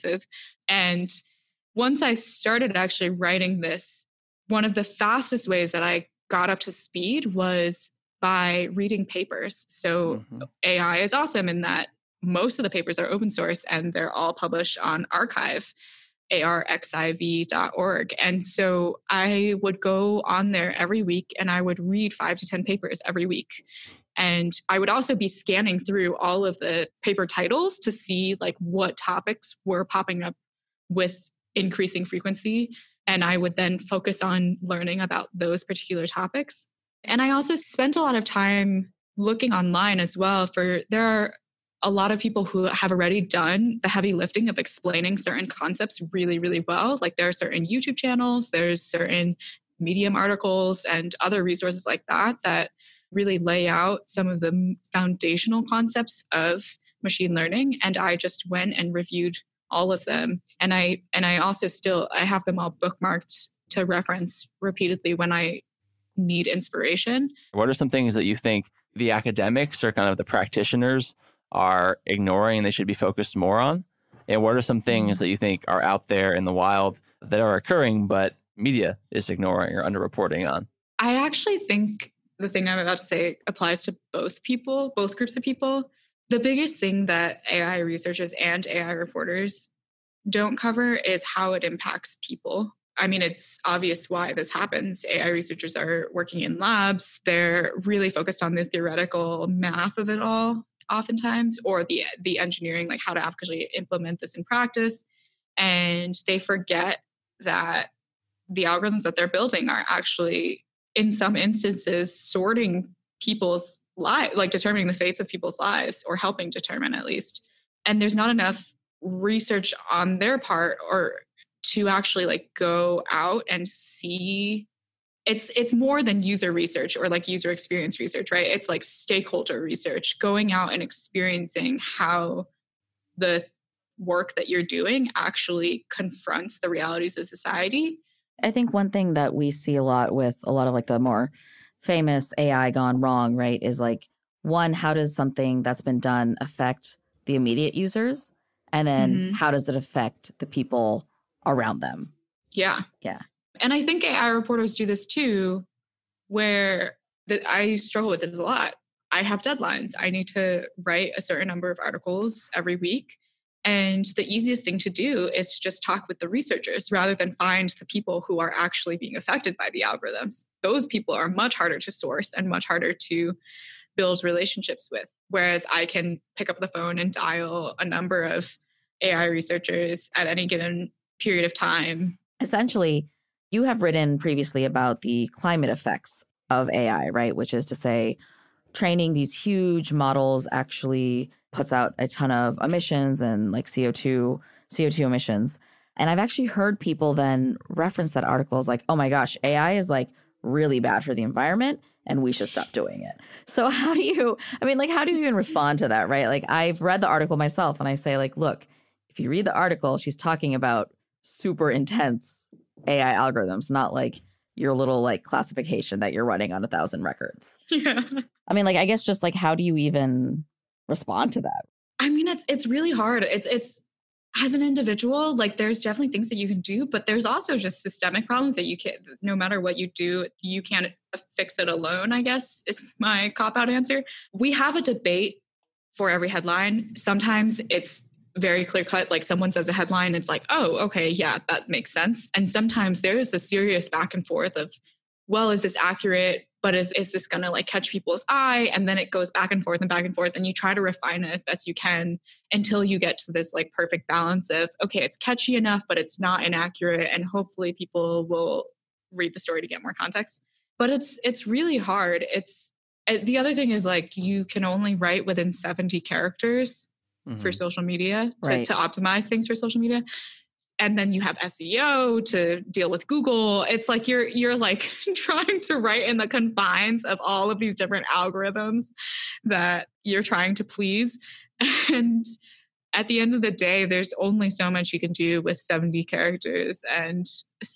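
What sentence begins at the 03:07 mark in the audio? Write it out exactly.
Which is to say, training these huge models actually puts out a ton of emissions and like CO2, CO2 emissions.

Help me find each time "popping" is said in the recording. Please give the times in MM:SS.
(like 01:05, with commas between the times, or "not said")
00:29.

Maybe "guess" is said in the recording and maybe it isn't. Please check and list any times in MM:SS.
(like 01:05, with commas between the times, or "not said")
03:38, 03:52.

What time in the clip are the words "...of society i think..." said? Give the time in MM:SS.
02:17.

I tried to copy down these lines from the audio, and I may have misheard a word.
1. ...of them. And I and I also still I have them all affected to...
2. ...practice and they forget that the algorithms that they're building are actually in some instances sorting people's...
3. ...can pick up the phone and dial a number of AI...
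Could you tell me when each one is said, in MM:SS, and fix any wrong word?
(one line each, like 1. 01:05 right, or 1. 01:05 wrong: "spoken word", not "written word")
1. 00:59 wrong: "bookmarked", not "affected"
2. 01:44 right
3. 02:55 right.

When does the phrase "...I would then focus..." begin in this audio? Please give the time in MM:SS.
00:33.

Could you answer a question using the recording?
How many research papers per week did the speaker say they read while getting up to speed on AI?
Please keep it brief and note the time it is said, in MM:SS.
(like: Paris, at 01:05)
5 to 10, at 00:22.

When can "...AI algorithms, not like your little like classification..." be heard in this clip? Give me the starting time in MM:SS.
03:32.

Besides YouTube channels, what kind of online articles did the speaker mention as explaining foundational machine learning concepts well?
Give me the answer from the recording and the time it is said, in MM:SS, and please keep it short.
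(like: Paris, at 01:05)
Medium articles, at 00:49.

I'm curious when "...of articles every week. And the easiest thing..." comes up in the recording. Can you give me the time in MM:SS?
02:41.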